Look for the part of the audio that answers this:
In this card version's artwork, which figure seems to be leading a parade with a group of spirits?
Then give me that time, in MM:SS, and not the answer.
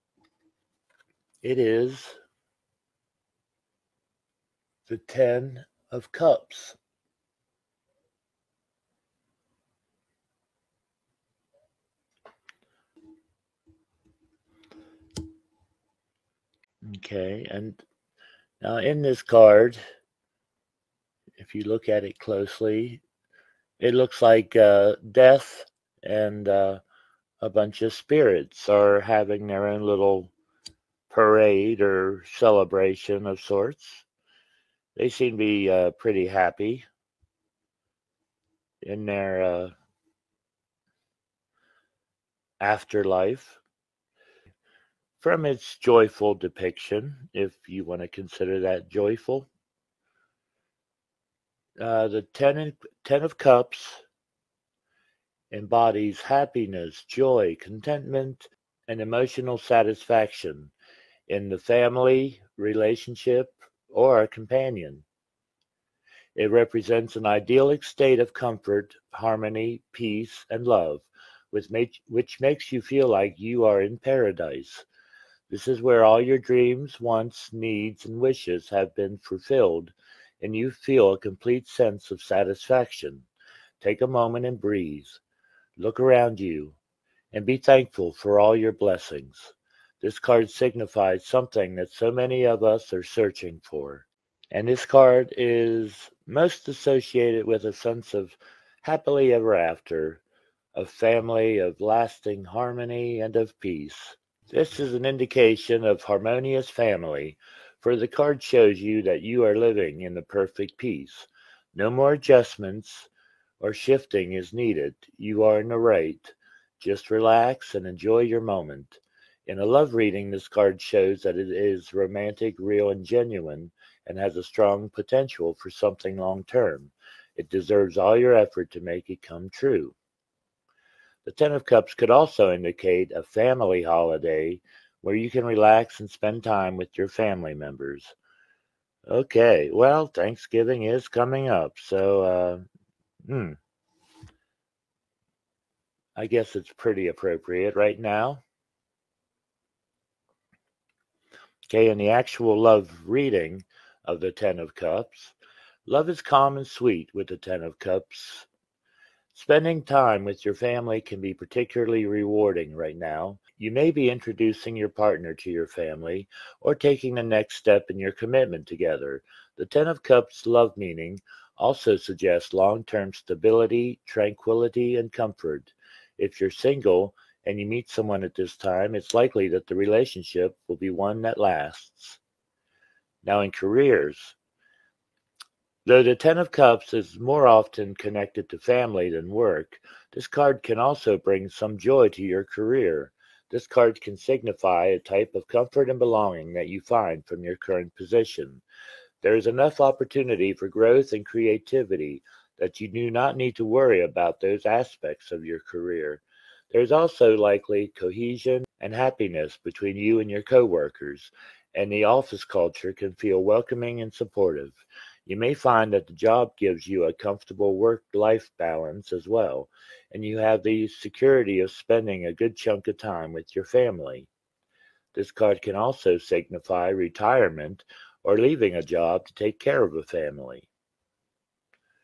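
00:25.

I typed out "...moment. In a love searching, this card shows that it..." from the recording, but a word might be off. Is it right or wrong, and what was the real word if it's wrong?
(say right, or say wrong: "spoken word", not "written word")
wrong: "reading", not "searching".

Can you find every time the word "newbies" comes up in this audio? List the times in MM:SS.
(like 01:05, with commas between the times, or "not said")
not said.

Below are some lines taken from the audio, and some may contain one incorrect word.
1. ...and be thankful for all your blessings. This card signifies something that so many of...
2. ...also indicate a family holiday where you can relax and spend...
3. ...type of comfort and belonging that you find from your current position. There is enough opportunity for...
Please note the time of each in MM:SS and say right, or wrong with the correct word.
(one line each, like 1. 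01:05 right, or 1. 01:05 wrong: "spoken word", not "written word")
1. 01:27 right
2. 02:12 right
3. 03:14 right.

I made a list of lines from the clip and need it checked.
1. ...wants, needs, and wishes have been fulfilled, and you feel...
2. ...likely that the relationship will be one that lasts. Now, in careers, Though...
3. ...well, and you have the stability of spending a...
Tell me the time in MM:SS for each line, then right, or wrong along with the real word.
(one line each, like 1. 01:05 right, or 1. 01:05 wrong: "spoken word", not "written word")
1. 01:16 right
2. 02:59 right
3. 03:39 wrong: "security", not "stability".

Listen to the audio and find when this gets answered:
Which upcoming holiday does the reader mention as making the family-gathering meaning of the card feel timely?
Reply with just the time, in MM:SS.
02:20.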